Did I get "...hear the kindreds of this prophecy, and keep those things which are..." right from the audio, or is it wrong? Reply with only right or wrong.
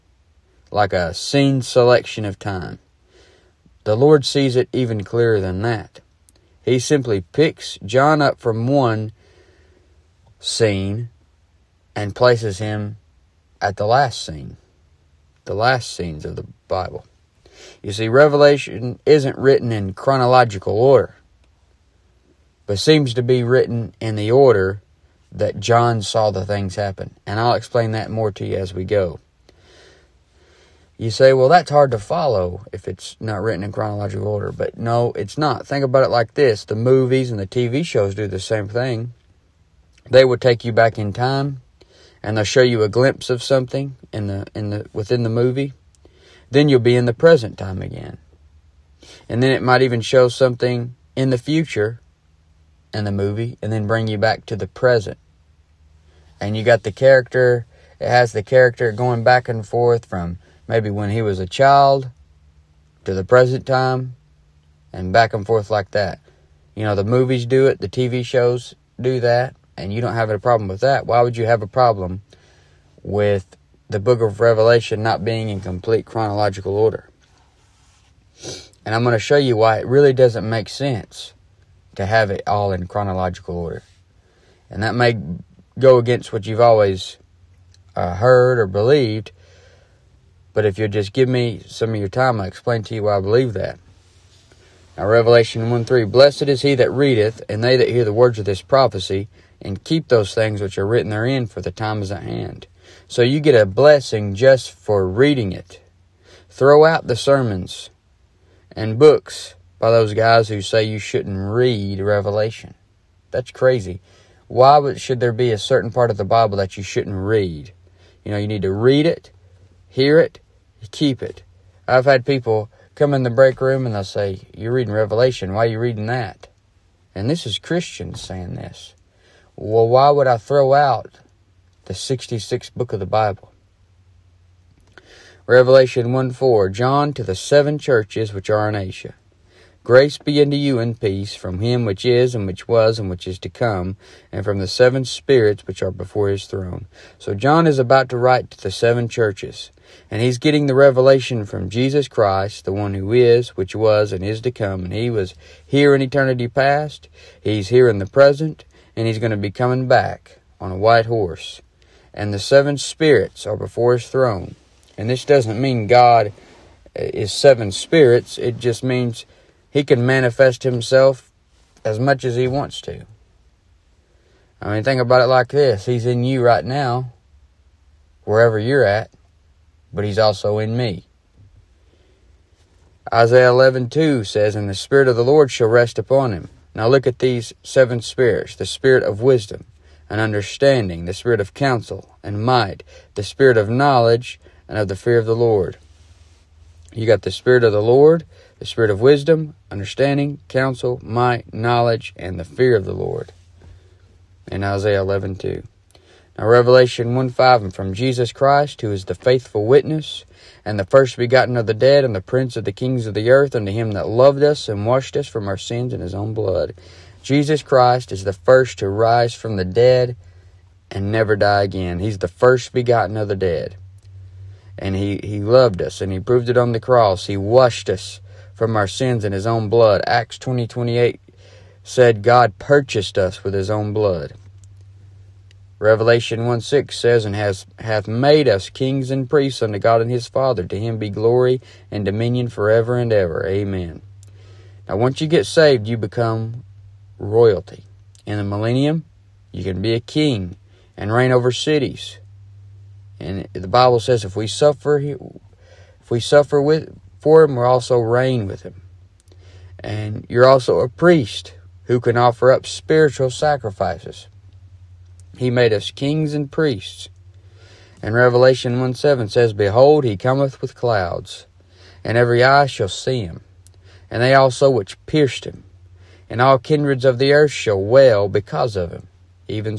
wrong.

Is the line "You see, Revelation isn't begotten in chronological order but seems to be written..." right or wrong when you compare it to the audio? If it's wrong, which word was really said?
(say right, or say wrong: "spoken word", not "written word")
wrong: "written", not "begotten".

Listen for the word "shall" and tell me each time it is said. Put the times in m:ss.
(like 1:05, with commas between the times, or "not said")
3:05, 4:32, 4:37.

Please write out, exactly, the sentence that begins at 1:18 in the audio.
And I'm going to show you why it really doesn't make sense to have it all in chronological order.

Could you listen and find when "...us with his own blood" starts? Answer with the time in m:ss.
3:53.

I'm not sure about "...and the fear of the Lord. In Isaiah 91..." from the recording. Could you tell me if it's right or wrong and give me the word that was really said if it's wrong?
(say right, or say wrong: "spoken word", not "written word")
wrong: "11", not "91".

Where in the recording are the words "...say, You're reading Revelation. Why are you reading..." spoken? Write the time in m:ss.
2:04.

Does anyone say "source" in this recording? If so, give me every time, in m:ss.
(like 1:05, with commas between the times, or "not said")
not said.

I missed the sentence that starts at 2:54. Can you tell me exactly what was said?
I mean, think about it like this He's in you right now, wherever you're at, but He's also in me.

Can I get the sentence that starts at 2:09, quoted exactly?
Well, why would I throw out the 66th book of the Bible?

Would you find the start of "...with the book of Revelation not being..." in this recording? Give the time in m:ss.
1:13.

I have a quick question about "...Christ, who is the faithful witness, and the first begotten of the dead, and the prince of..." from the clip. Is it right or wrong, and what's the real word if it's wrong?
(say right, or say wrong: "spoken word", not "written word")
right.